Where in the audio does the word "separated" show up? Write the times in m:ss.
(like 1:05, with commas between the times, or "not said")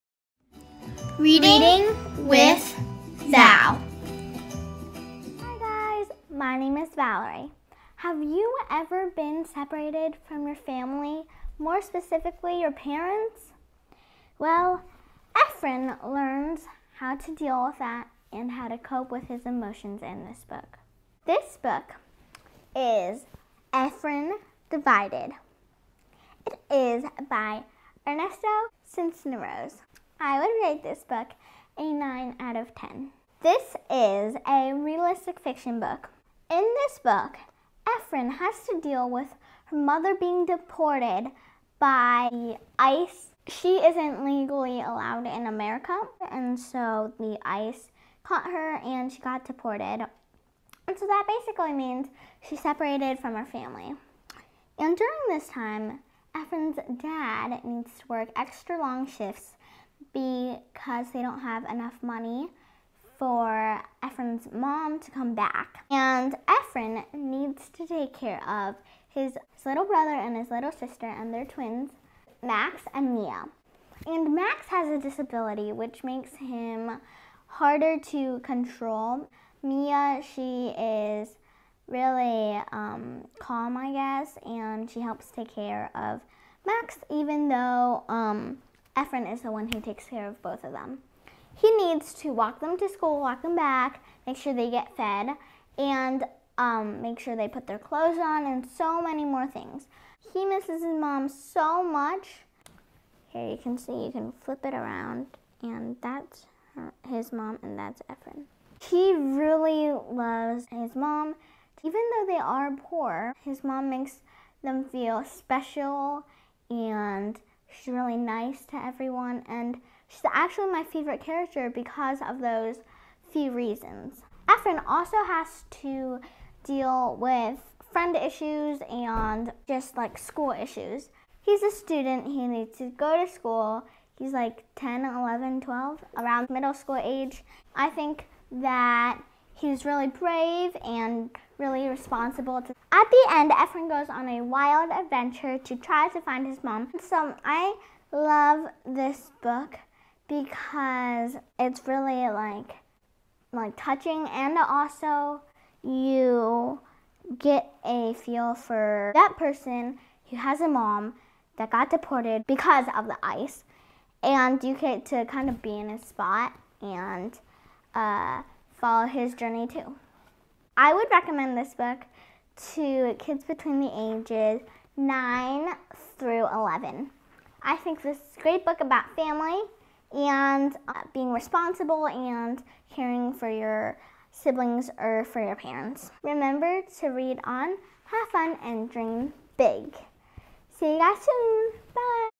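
0:09, 0:52.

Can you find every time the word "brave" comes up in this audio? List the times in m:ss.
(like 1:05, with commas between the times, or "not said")
2:20.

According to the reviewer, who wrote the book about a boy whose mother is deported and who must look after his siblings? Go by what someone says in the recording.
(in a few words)
Ernesto Rose.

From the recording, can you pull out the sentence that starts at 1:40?
He misses his mom so much.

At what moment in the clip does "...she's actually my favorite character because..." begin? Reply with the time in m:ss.
2:00.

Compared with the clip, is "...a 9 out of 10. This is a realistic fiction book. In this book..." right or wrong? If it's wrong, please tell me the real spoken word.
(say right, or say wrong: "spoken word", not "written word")
right.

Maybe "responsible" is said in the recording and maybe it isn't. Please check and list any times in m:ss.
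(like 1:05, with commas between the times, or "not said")
2:21, 3:01.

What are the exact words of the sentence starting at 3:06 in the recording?
Remember to read on, have fun, and dream big.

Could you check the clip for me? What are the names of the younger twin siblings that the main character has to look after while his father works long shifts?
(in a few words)
Max and Mia.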